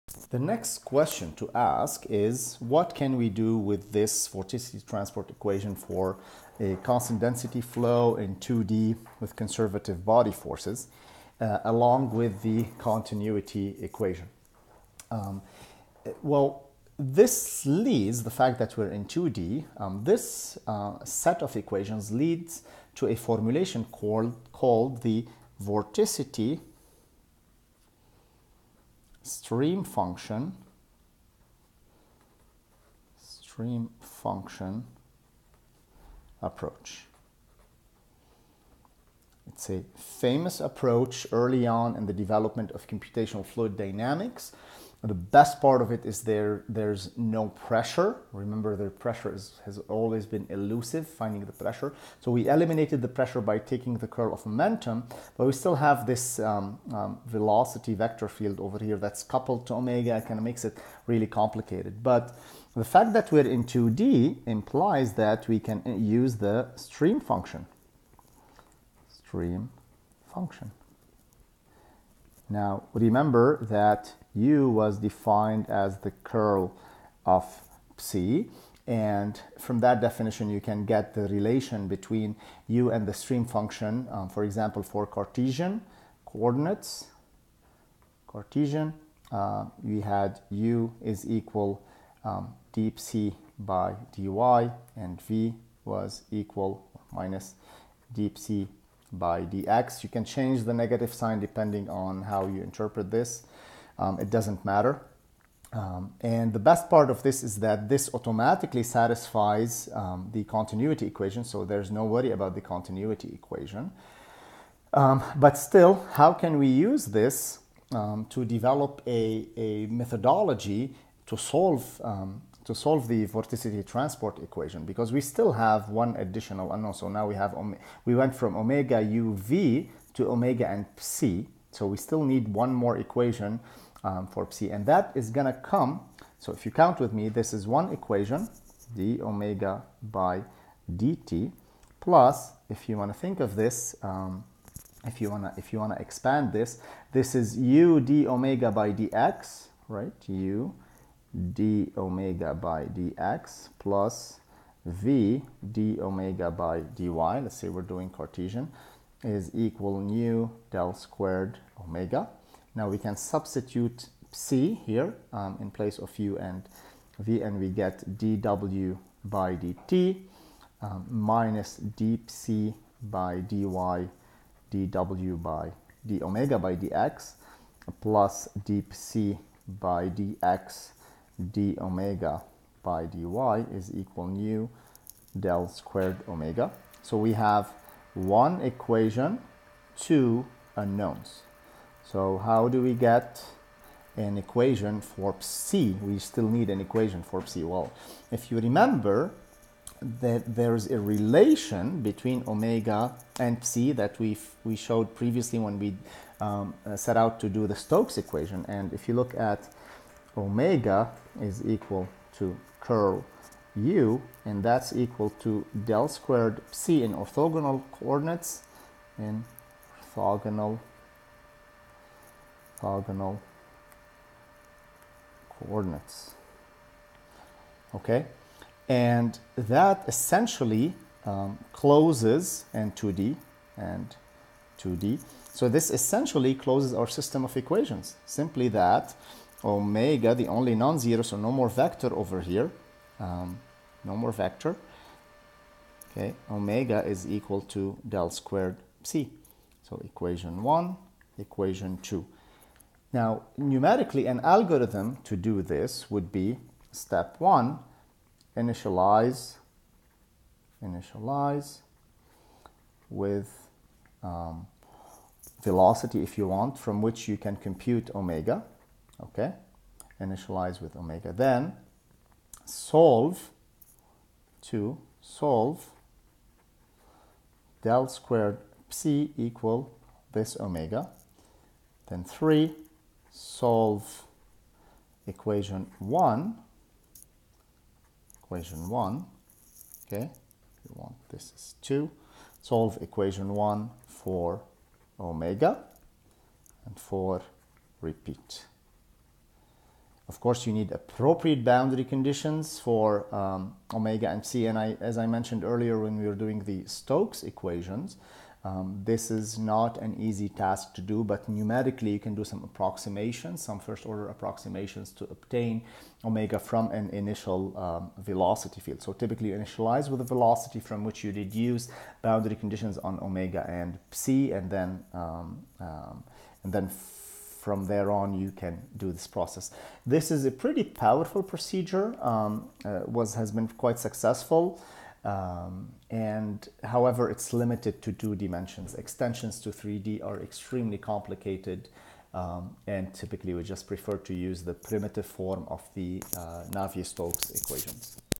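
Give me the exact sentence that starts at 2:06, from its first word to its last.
Uh, so now we have we went from omega uv to omega and psi.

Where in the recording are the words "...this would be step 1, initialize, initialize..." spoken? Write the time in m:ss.
4:15.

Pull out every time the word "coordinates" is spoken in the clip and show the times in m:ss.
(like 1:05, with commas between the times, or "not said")
1:26, 3:37, 3:45.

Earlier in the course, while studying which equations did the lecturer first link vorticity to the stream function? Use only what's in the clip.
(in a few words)
Stokes equations.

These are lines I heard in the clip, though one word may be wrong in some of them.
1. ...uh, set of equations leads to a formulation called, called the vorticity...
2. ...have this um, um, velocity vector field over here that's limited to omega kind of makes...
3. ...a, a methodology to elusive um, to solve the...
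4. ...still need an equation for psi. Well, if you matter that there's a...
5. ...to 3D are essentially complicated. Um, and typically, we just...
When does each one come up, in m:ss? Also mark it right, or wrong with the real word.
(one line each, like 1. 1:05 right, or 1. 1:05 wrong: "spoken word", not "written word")
1. 0:20 right
2. 0:55 wrong: "coupled", not "limited"
3. 1:59 wrong: "solve", not "elusive"
4. 3:16 wrong: "remember", not "matter"
5. 5:39 wrong: "extremely", not "essentially".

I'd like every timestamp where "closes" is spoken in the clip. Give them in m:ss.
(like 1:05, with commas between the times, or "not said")
3:51, 3:56.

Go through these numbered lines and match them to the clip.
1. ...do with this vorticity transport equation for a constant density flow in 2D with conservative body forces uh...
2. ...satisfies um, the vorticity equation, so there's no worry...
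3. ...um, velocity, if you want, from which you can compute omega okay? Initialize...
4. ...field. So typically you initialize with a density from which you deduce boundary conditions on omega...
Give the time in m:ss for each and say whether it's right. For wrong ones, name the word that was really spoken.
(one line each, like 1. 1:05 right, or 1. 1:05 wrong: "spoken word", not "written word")
1. 0:03 right
2. 1:48 wrong: "continuity", not "vorticity"
3. 4:24 right
4. 5:18 wrong: "velocity", not "density".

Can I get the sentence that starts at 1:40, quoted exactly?
You can change the negative sign depending on how you interpret this.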